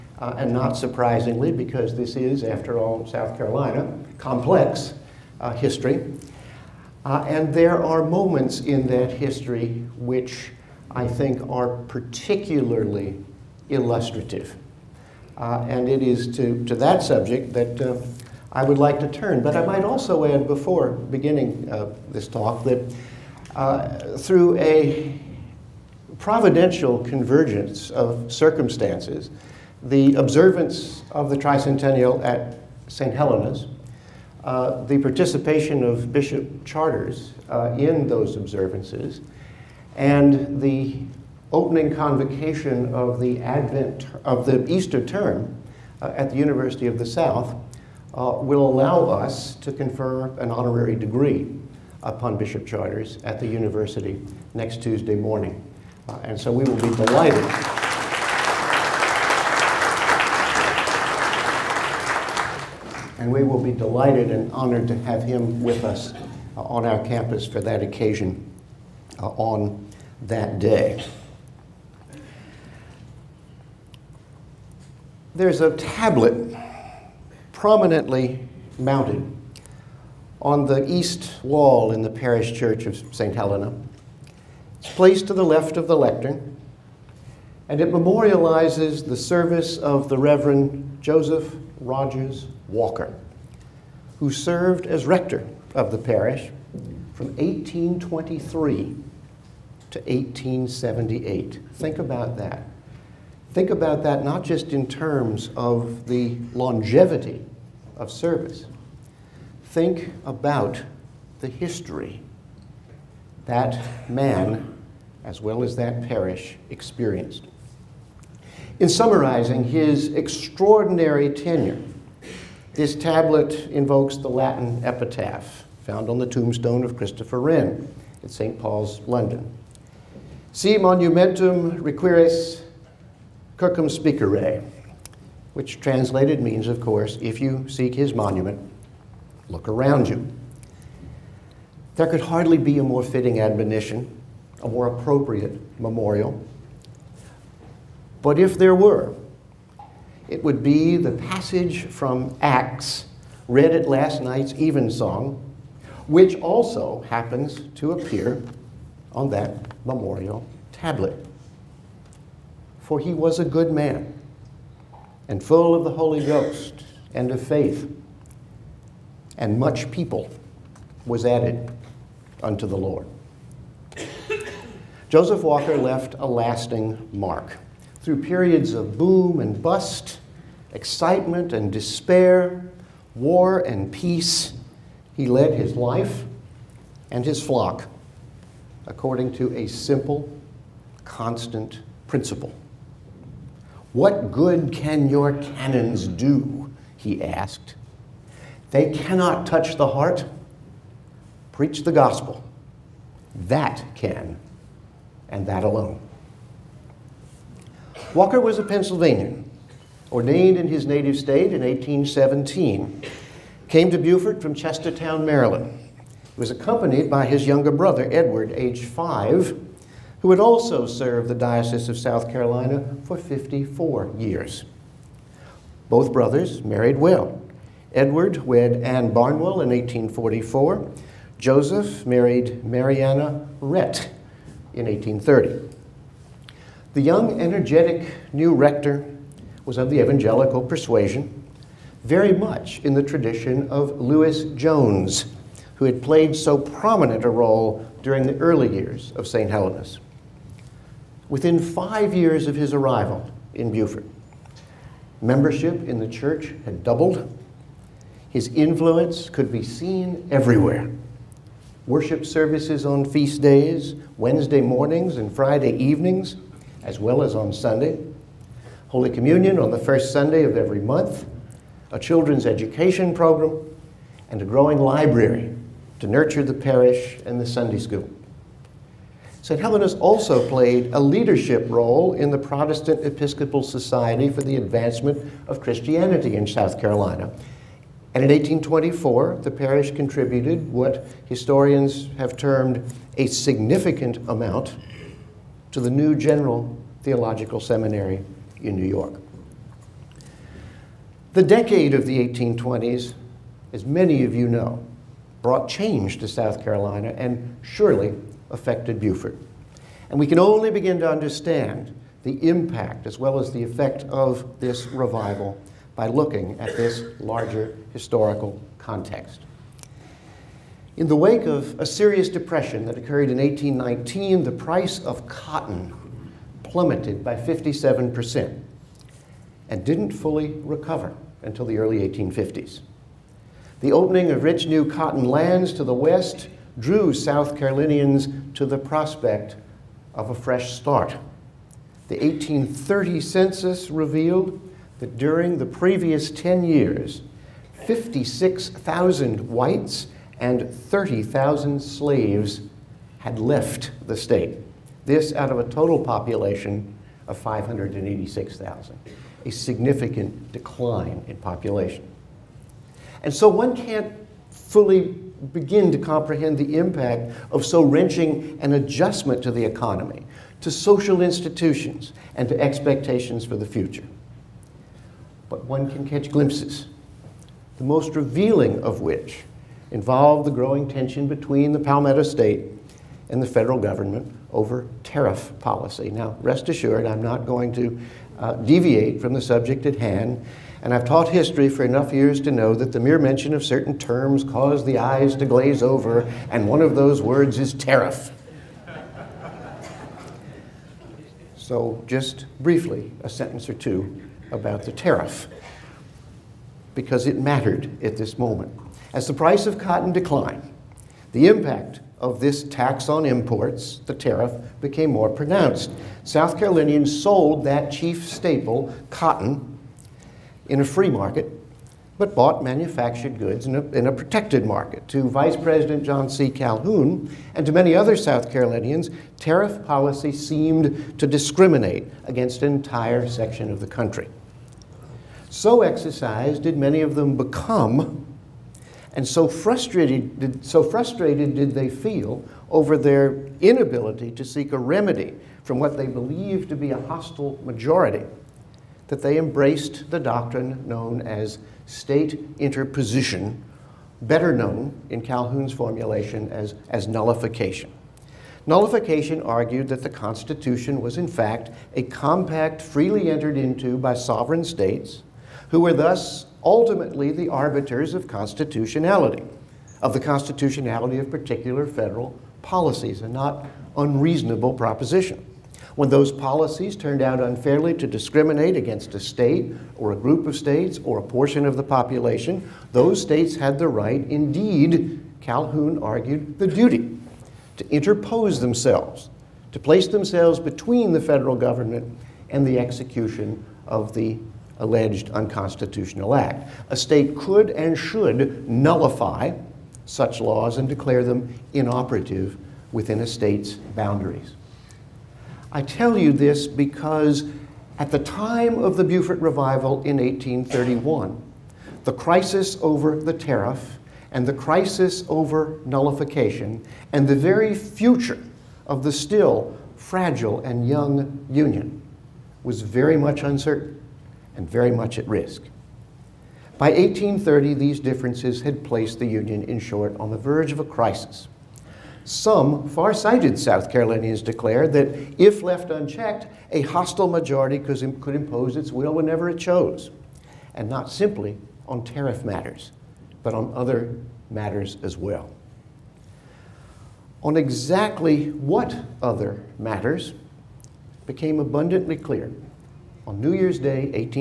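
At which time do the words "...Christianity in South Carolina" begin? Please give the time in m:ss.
4:45.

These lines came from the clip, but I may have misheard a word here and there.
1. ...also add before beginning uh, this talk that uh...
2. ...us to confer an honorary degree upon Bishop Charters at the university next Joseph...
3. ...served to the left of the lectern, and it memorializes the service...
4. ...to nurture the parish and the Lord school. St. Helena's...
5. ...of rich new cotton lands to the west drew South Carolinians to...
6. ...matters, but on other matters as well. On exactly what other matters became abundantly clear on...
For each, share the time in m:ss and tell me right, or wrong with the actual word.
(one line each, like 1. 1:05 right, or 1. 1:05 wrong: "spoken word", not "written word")
1. 0:19 right
2. 0:49 wrong: "Tuesday", not "Joseph"
3. 1:24 wrong: "placed", not "served"
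4. 4:36 wrong: "Sunday", not "Lord"
5. 5:34 right
6. 9:02 right.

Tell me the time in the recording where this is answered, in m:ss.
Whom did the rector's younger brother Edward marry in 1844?
3:48.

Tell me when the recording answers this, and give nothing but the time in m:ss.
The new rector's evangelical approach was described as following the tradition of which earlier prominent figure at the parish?
4:03.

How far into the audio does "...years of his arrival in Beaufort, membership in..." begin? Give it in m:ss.
4:12.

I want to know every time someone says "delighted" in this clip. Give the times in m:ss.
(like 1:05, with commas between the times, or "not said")
0:56, 1:03.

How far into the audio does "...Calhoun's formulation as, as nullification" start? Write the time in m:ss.
7:35.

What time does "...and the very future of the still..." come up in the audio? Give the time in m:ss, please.
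8:37.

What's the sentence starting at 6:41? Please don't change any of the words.
so, just briefly, a sentence or two about the tariff, because it mattered at this moment.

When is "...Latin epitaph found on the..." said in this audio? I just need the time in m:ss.
2:04.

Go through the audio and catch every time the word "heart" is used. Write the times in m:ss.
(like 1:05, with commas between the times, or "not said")
3:19.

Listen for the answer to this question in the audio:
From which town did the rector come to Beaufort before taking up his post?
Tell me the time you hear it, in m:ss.
3:34.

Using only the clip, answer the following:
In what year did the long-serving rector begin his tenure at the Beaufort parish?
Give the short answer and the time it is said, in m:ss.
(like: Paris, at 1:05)
1823, at 1:37.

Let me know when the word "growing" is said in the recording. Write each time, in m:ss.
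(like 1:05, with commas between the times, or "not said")
4:34, 6:20.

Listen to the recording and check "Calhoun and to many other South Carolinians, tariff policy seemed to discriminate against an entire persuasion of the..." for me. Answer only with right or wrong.
wrong.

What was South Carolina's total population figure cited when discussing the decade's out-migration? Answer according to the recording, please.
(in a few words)
586,000.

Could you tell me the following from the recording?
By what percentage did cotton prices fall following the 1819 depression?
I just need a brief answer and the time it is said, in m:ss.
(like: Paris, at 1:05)
57%, at 5:27.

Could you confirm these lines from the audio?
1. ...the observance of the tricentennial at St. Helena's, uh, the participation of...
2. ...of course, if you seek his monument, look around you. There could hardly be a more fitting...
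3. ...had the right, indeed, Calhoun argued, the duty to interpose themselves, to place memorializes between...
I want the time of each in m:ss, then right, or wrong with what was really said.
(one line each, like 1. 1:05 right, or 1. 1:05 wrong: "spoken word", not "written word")
1. 0:29 right
2. 2:16 right
3. 8:03 wrong: "themselves", not "memorializes".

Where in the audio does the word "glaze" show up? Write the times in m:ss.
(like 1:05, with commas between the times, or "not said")
6:35.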